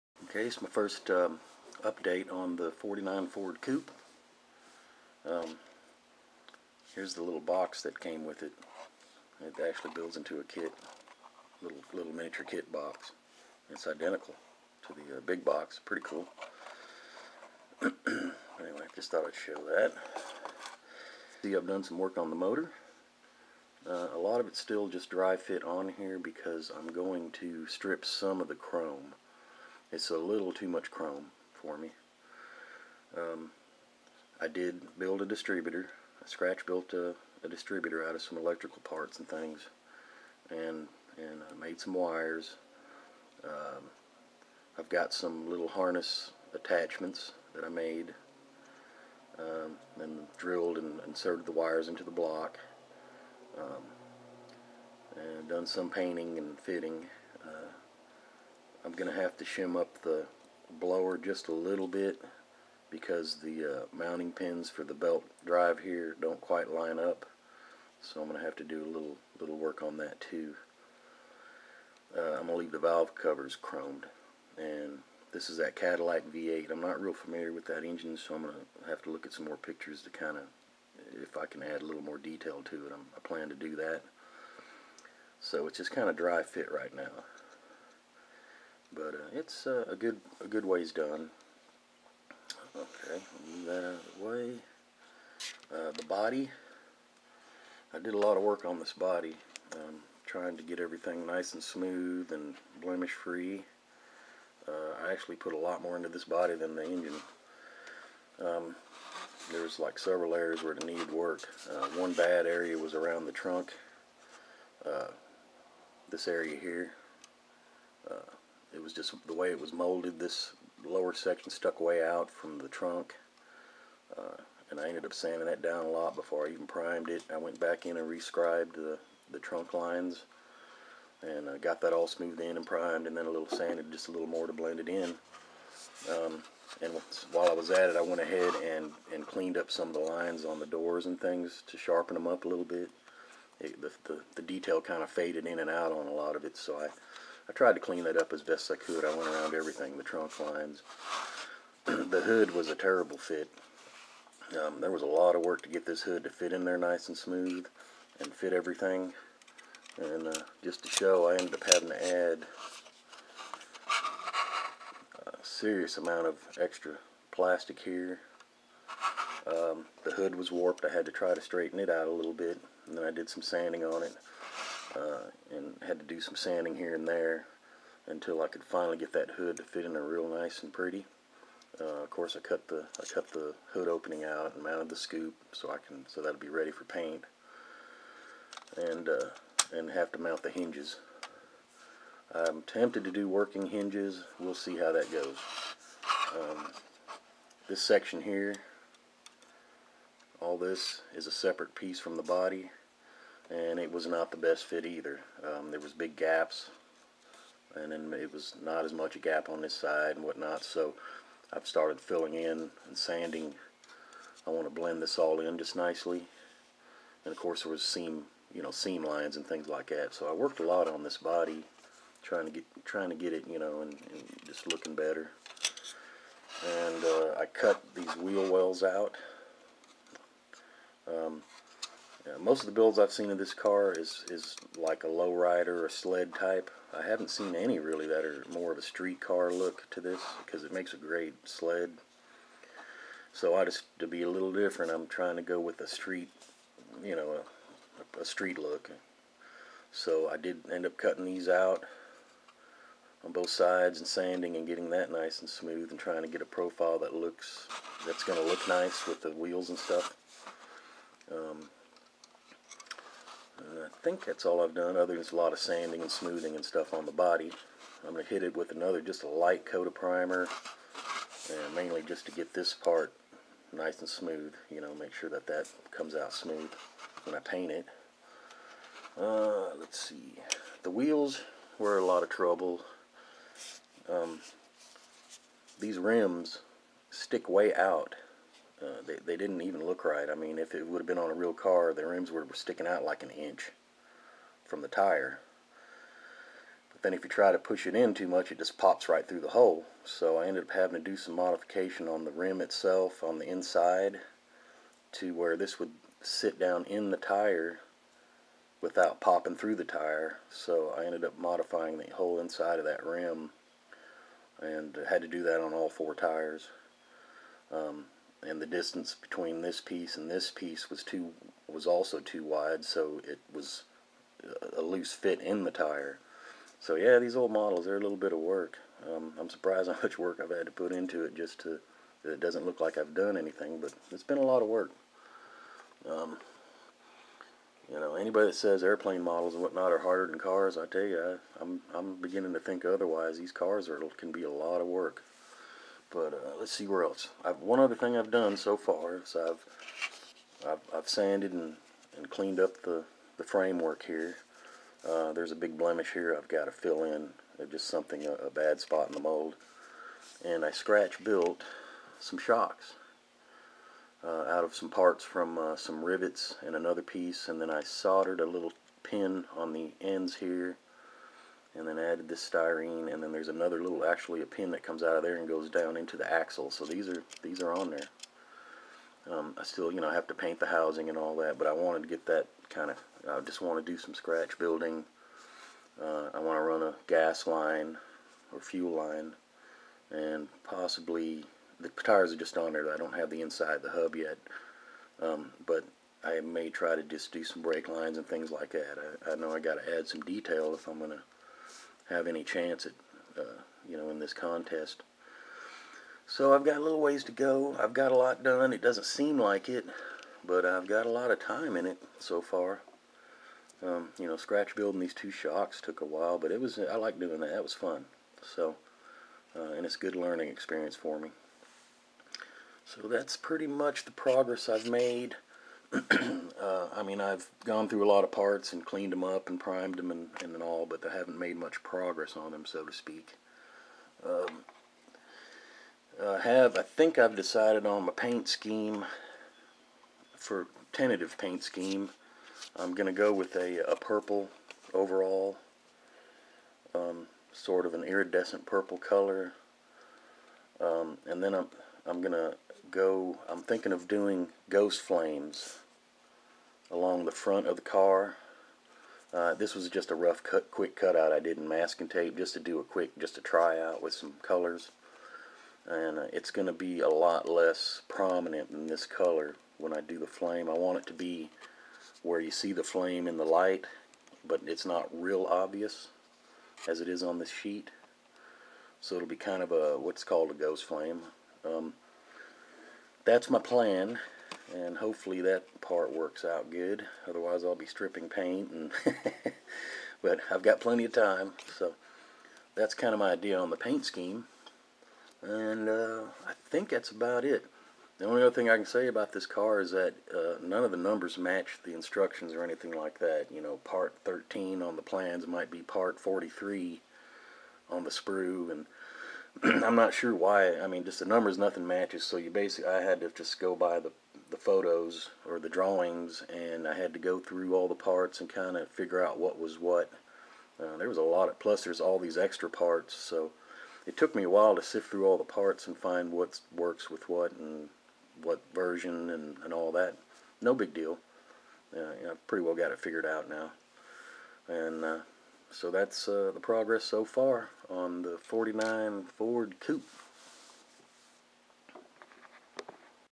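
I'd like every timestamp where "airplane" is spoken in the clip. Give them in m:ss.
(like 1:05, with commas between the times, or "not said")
5:38.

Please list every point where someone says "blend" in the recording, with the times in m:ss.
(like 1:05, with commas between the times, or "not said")
2:14, 3:34.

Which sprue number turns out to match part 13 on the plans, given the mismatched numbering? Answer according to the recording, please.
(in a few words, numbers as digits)
43.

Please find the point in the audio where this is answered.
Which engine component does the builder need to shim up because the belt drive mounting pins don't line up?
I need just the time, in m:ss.
1:00.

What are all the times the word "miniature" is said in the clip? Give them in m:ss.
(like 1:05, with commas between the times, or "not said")
0:12.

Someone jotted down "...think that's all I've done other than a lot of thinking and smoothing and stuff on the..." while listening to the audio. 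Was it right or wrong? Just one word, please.
wrong.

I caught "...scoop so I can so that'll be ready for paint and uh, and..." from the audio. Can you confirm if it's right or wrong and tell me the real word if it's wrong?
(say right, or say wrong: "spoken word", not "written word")
right.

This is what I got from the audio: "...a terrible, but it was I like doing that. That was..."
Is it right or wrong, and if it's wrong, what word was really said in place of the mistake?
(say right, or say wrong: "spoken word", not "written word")
wrong: "while", not "terrible".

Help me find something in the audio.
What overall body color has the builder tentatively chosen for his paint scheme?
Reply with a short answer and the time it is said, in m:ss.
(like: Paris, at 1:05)
iridescent purple, at 7:28.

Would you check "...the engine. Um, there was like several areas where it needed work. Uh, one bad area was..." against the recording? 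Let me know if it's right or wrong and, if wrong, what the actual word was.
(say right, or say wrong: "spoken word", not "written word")
right.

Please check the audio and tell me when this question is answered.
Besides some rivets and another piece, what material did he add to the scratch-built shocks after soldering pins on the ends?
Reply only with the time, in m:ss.
6:12.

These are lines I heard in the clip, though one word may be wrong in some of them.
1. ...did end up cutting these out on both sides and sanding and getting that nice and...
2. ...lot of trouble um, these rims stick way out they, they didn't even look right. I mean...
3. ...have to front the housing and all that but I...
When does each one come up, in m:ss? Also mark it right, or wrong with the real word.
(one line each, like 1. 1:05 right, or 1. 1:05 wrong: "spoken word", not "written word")
1. 4:10 right
2. 4:42 right
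3. 6:20 wrong: "paint", not "front".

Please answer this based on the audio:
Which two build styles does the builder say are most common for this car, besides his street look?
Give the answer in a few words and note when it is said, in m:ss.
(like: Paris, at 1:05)
lowrider or sled, at 3:55.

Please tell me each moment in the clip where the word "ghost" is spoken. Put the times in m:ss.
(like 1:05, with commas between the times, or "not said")
7:34, 8:00.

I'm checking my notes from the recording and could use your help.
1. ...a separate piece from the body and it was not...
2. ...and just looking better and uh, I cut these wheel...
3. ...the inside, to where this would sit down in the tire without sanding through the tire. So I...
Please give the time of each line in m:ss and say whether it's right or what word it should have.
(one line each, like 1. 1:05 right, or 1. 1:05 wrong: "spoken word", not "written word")
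1. 3:21 right
2. 3:43 right
3. 5:03 wrong: "popping", not "sanding".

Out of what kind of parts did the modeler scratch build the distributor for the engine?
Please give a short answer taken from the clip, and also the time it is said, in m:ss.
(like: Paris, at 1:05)
electrical parts, at 0:38.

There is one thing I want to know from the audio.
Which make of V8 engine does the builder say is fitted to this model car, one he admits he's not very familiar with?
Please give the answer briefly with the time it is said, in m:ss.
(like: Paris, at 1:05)
Cadillac, at 1:15.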